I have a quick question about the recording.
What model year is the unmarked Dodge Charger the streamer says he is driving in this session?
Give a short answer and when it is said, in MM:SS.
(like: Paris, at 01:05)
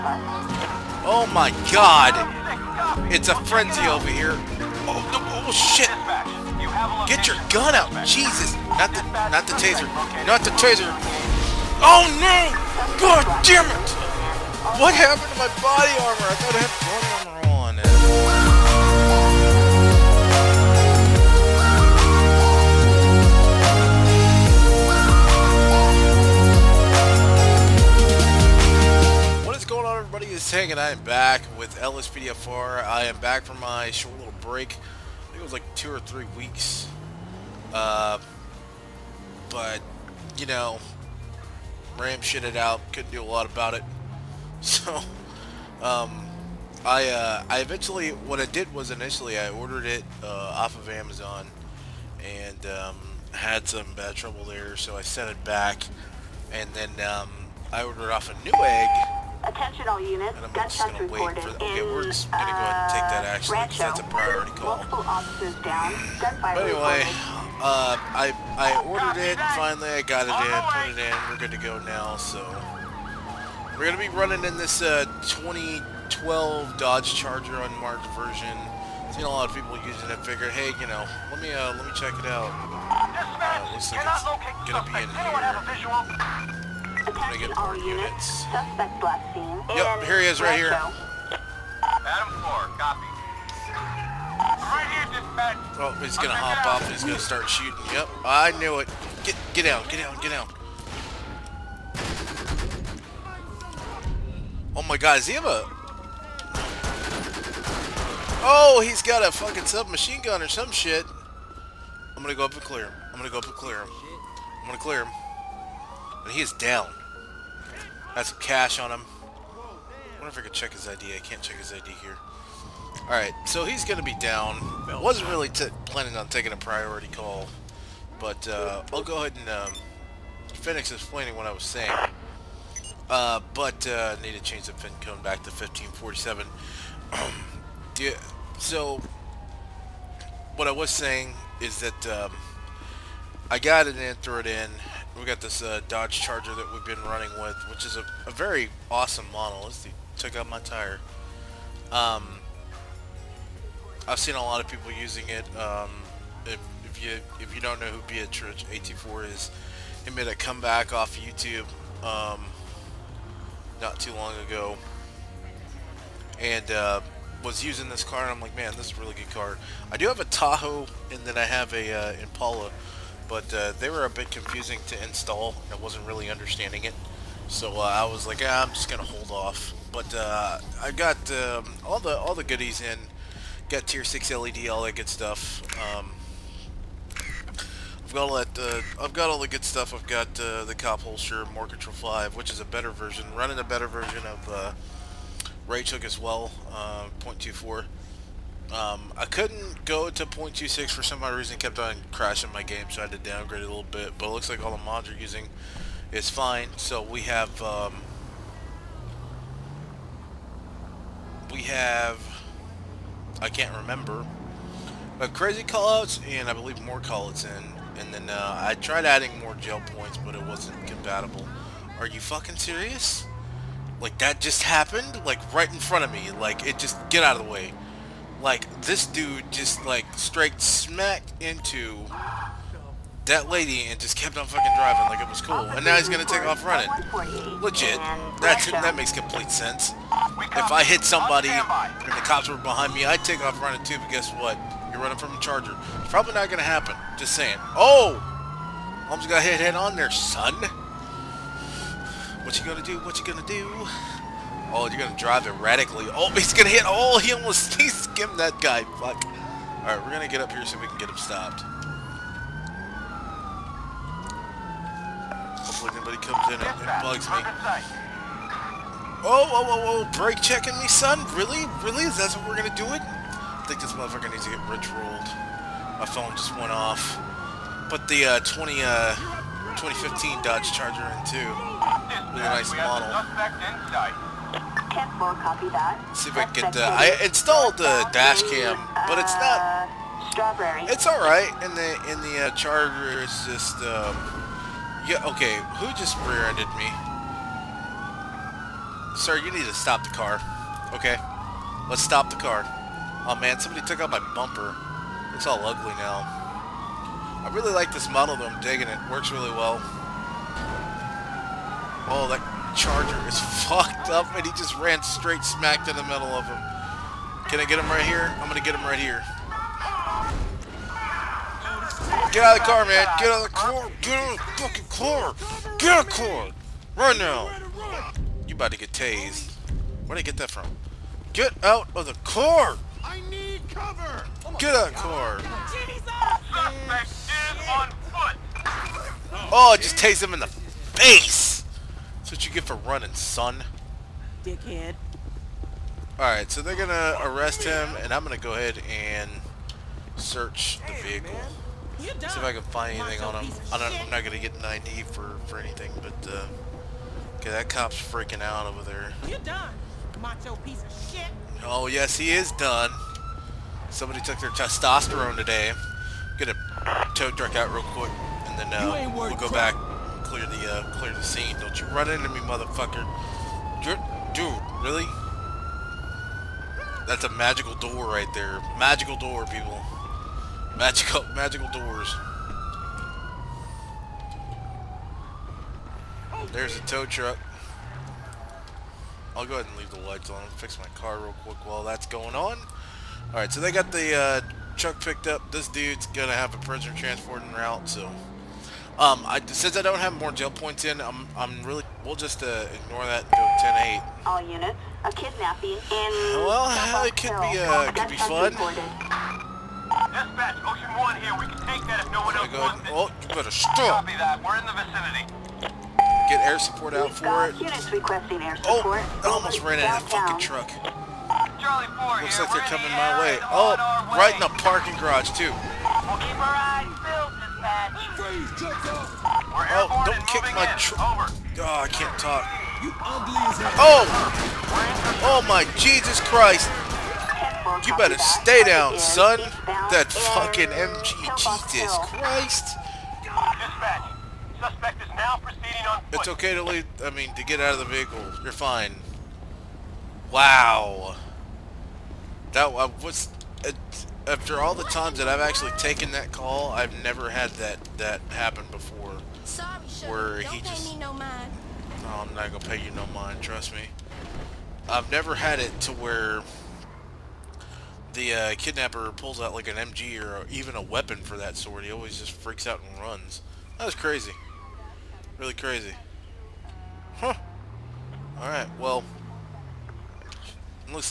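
2012, at 01:15.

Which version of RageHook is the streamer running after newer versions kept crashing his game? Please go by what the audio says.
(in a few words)
0.24.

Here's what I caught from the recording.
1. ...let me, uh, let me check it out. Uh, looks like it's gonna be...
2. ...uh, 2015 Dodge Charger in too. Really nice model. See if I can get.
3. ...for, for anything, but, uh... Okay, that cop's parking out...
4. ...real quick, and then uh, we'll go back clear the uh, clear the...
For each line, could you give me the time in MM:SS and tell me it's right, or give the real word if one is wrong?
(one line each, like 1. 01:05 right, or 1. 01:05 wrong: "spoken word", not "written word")
1. 01:21 right
2. 04:38 right
3. 05:55 wrong: "freaking", not "parking"
4. 06:07 right.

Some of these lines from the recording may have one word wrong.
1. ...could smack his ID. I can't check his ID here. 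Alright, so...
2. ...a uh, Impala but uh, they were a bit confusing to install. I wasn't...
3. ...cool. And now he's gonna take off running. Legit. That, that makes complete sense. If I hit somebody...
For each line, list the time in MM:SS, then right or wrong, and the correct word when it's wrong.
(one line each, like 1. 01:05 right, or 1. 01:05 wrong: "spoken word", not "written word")
1. 02:00 wrong: "check", not "smack"
2. 02:51 right
3. 03:55 right.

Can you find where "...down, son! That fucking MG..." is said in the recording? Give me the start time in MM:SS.
07:18.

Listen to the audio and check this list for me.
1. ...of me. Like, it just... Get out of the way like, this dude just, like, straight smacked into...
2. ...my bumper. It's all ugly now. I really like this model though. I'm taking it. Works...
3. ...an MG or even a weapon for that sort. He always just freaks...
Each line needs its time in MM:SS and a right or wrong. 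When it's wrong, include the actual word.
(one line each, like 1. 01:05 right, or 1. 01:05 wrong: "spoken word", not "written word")
1. 03:46 right
2. 05:04 wrong: "digging", not "taking"
3. 07:49 right.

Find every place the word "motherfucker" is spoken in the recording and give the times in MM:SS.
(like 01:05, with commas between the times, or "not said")
04:33, 06:12.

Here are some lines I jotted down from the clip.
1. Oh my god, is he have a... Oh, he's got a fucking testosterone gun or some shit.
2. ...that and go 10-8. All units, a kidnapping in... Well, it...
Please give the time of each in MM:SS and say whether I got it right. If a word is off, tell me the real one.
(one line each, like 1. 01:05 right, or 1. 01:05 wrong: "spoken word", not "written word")
1. 01:44 wrong: "submachine", not "testosterone"
2. 06:43 right.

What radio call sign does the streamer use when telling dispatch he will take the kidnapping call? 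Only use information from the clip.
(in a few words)
Ocean 1.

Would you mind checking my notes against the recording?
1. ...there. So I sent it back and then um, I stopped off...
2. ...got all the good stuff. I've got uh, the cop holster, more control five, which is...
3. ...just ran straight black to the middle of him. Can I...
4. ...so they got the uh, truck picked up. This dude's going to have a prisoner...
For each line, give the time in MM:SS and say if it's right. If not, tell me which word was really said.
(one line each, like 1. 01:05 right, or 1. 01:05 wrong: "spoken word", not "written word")
1. 00:54 wrong: "ordered", not "stopped"
2. 03:09 right
3. 05:14 wrong: "smack", not "black"
4. 06:33 right.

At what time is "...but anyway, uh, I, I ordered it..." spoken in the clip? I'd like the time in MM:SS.
01:06.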